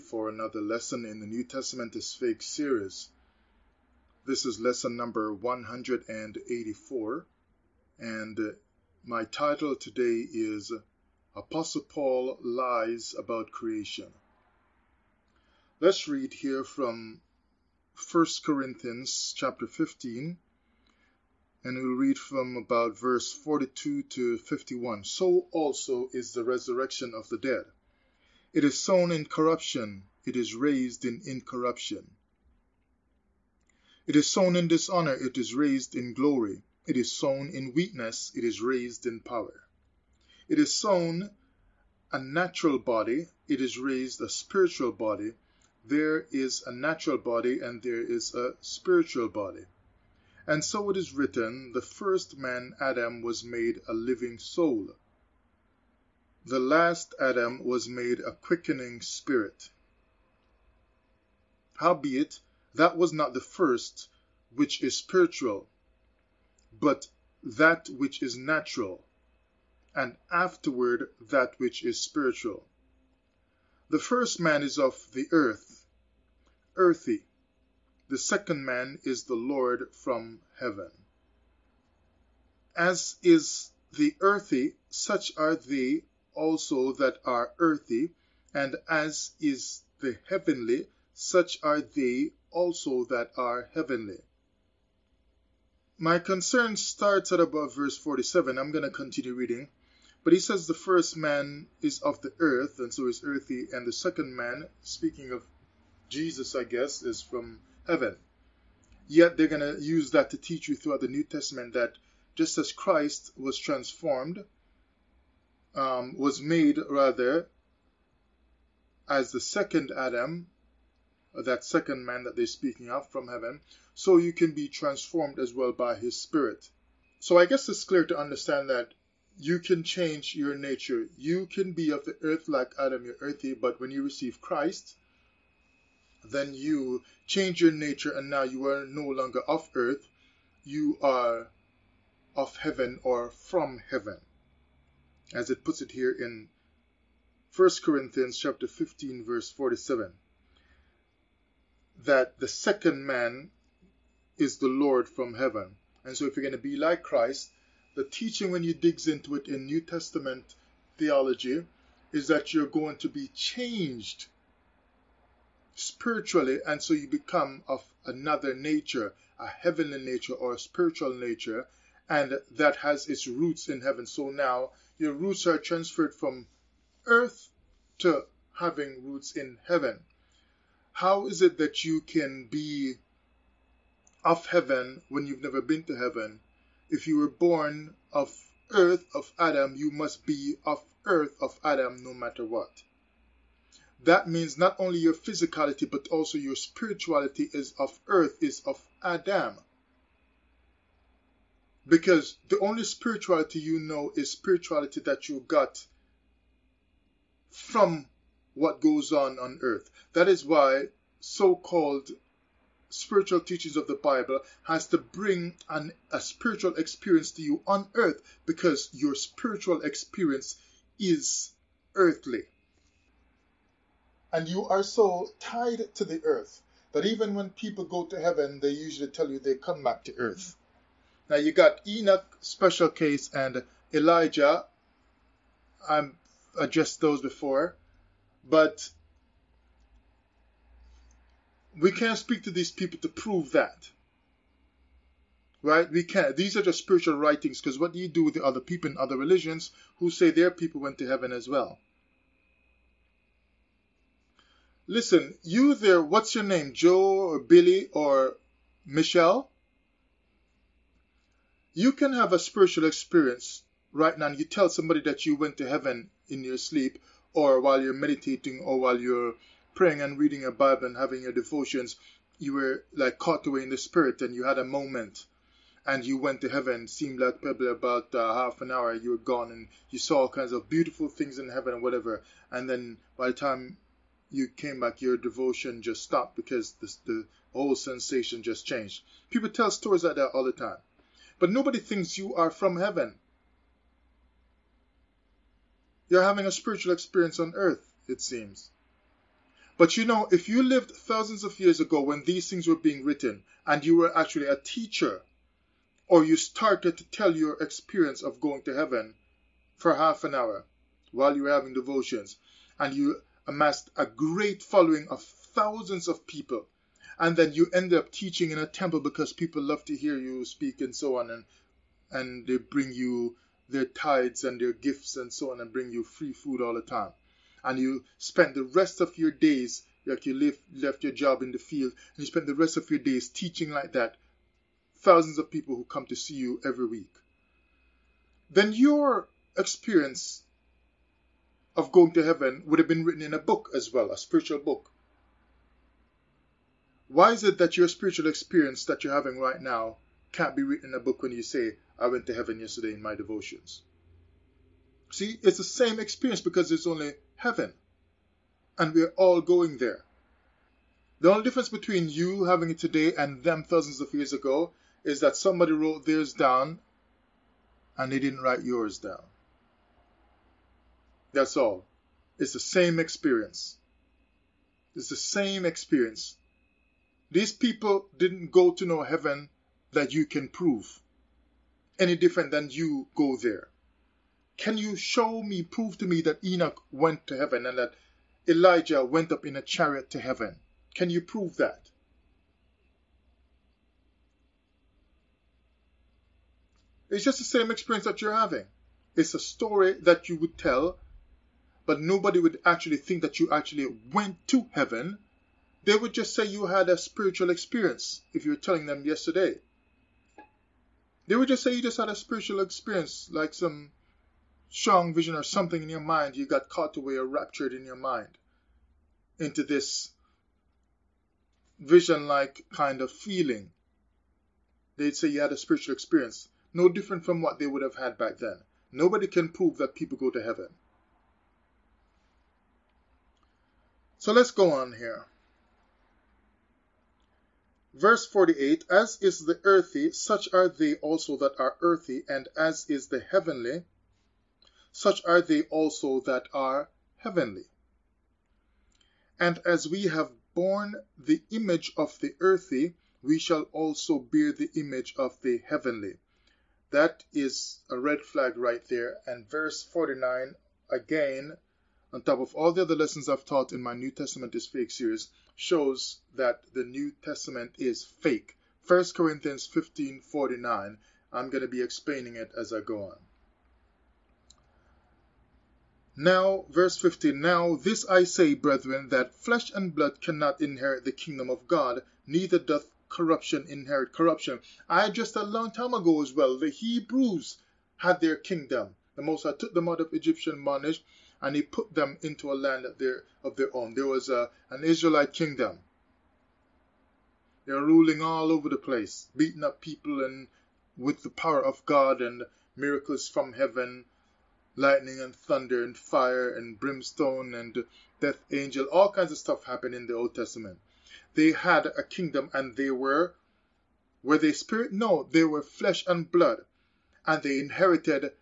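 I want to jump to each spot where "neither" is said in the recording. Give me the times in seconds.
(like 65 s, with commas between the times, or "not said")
482 s.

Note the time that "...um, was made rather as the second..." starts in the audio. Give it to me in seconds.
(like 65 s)
115 s.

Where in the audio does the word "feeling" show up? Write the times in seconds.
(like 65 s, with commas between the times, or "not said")
423 s.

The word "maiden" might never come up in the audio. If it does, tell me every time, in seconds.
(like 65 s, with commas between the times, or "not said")
not said.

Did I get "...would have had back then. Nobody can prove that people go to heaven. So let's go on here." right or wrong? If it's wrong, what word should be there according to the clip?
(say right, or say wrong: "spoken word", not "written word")
right.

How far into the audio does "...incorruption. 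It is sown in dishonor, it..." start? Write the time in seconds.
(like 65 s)
31 s.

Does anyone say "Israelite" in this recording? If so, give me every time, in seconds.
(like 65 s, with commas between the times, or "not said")
494 s.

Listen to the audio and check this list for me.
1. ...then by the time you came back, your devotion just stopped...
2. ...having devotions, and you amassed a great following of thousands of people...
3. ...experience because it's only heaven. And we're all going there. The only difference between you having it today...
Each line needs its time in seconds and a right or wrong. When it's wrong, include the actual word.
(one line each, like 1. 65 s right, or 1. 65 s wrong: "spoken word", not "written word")
1. 282 s right
2. 311 s right
3. 356 s right.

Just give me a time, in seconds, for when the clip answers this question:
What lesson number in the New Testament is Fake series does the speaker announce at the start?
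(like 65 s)
5 s.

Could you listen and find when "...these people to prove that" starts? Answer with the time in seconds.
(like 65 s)
242 s.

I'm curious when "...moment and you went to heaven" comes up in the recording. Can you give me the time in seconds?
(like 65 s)
274 s.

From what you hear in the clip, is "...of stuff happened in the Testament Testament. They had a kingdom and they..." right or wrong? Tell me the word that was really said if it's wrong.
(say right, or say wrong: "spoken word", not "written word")
wrong: "Old", not "Testament".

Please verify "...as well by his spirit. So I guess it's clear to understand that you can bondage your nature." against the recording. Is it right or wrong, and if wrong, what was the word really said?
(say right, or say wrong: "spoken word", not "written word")
wrong: "change", not "bondage".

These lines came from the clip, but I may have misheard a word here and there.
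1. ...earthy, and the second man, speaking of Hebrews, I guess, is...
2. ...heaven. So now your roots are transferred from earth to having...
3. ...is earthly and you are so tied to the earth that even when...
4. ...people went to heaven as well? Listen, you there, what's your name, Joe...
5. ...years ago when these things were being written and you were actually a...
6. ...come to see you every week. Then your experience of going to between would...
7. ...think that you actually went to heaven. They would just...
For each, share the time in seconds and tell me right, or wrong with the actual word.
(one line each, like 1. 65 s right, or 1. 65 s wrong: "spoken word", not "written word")
1. 103 s wrong: "Jesus", not "Hebrews"
2. 173 s right
3. 220 s right
4. 250 s right
5. 301 s right
6. 335 s wrong: "heaven", not "between"
7. 402 s right.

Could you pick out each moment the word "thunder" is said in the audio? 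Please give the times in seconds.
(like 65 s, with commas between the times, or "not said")
505 s.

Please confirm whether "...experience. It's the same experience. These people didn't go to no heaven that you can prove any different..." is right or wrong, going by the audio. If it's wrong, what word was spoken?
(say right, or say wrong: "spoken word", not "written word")
right.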